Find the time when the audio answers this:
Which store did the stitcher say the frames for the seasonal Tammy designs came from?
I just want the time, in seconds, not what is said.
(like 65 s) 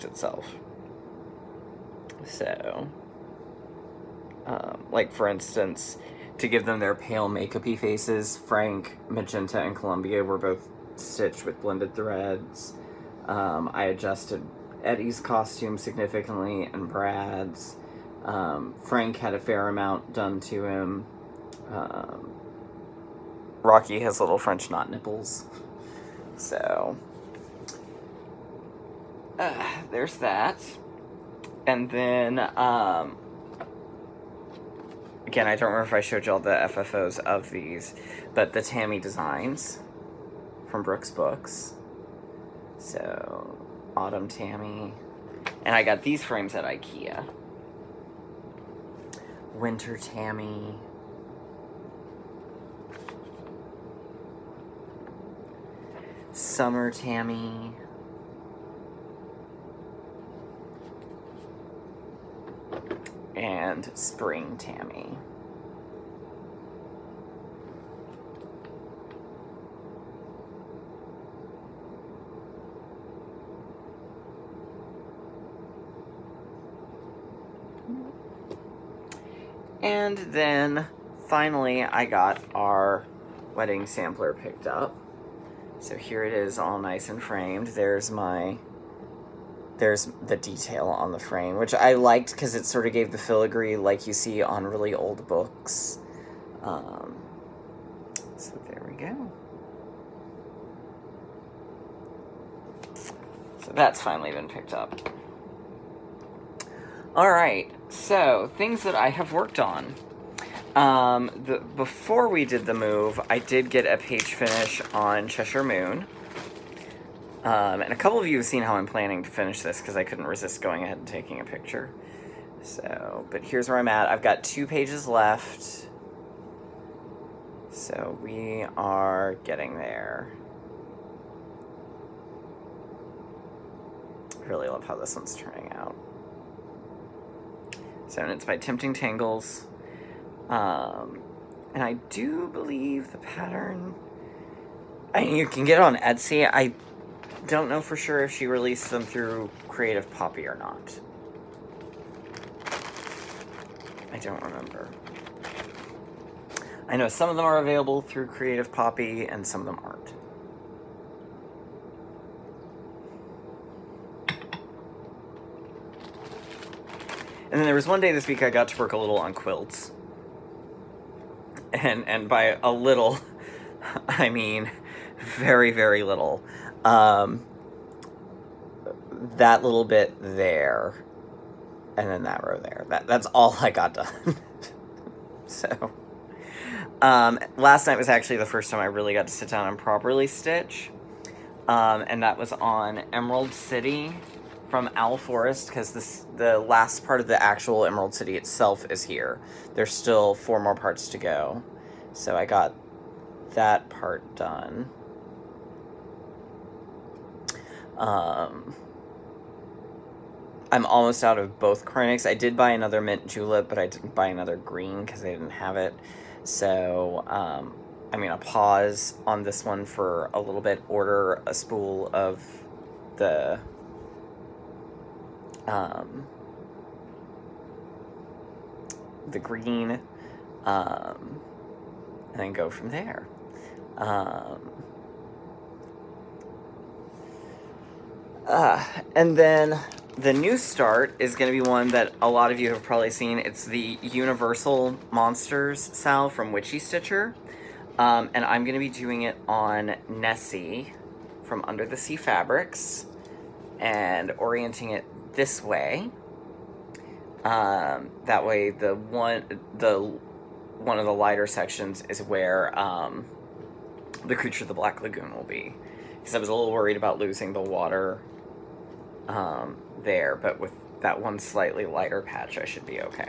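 46 s.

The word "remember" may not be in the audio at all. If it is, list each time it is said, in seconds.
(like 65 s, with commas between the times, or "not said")
35 s, 154 s.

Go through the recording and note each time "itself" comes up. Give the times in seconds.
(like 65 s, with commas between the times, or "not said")
0 s, 198 s.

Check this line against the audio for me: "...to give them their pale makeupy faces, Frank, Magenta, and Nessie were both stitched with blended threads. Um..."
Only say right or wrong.
wrong.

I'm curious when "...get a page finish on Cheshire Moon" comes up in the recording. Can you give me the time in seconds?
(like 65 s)
113 s.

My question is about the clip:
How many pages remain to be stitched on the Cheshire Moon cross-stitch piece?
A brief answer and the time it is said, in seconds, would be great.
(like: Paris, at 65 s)
2, at 124 s.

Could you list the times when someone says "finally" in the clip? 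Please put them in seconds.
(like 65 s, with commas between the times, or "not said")
81 s, 104 s.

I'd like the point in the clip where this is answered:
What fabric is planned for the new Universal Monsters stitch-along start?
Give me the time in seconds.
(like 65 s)
250 s.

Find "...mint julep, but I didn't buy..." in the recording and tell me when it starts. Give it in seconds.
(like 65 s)
212 s.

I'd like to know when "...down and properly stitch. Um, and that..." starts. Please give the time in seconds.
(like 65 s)
189 s.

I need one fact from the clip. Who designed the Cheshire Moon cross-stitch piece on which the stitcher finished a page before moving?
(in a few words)
Tempting Tangles.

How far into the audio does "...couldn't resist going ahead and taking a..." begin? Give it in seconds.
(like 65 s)
120 s.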